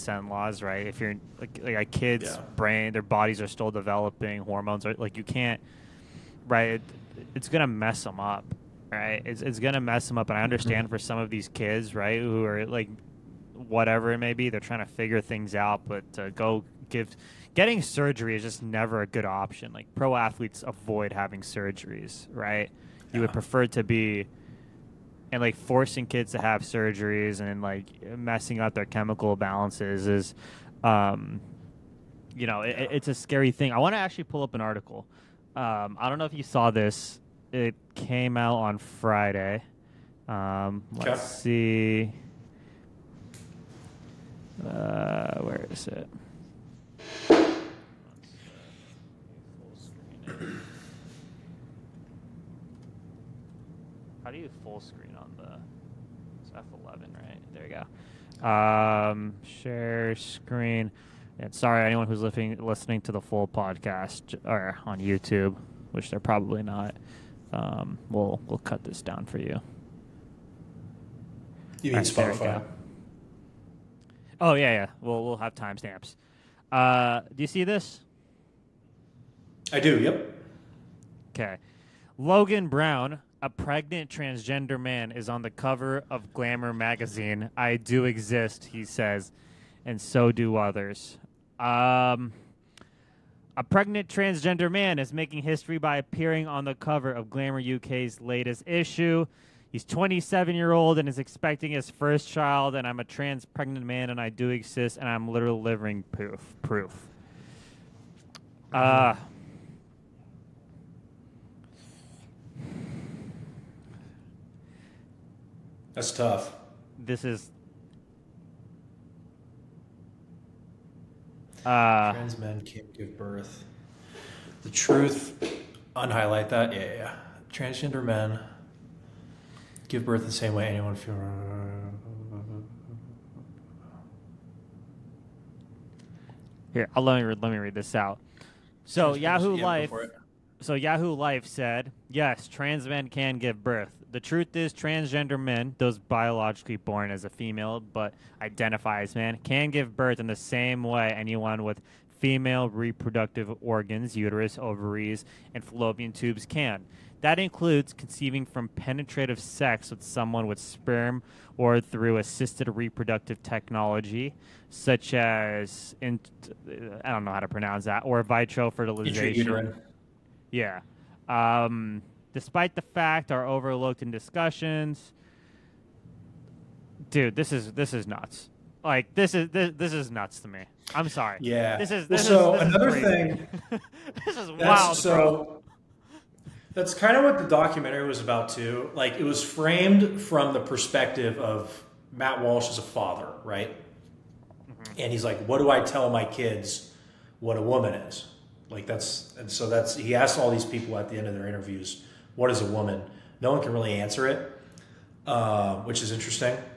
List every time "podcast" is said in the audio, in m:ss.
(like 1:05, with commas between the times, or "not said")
1:03.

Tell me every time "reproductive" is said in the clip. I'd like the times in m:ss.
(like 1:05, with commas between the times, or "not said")
2:32, 2:42.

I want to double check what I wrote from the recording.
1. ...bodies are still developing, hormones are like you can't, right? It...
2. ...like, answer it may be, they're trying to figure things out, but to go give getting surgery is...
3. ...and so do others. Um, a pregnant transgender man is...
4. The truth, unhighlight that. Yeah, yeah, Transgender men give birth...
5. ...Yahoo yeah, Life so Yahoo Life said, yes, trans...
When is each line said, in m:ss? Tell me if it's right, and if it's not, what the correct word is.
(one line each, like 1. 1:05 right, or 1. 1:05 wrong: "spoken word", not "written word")
1. 0:03 right
2. 0:12 wrong: "whatever", not "answer"
3. 1:29 right
4. 2:04 right
5. 2:19 right.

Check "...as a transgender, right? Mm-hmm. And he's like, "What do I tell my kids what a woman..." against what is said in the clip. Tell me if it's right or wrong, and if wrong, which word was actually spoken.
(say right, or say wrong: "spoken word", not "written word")
wrong: "father", not "transgender".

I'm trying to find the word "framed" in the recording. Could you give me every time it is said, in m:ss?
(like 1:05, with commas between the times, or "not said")
3:09.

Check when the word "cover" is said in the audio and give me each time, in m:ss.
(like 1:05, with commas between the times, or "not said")
1:25, 1:36.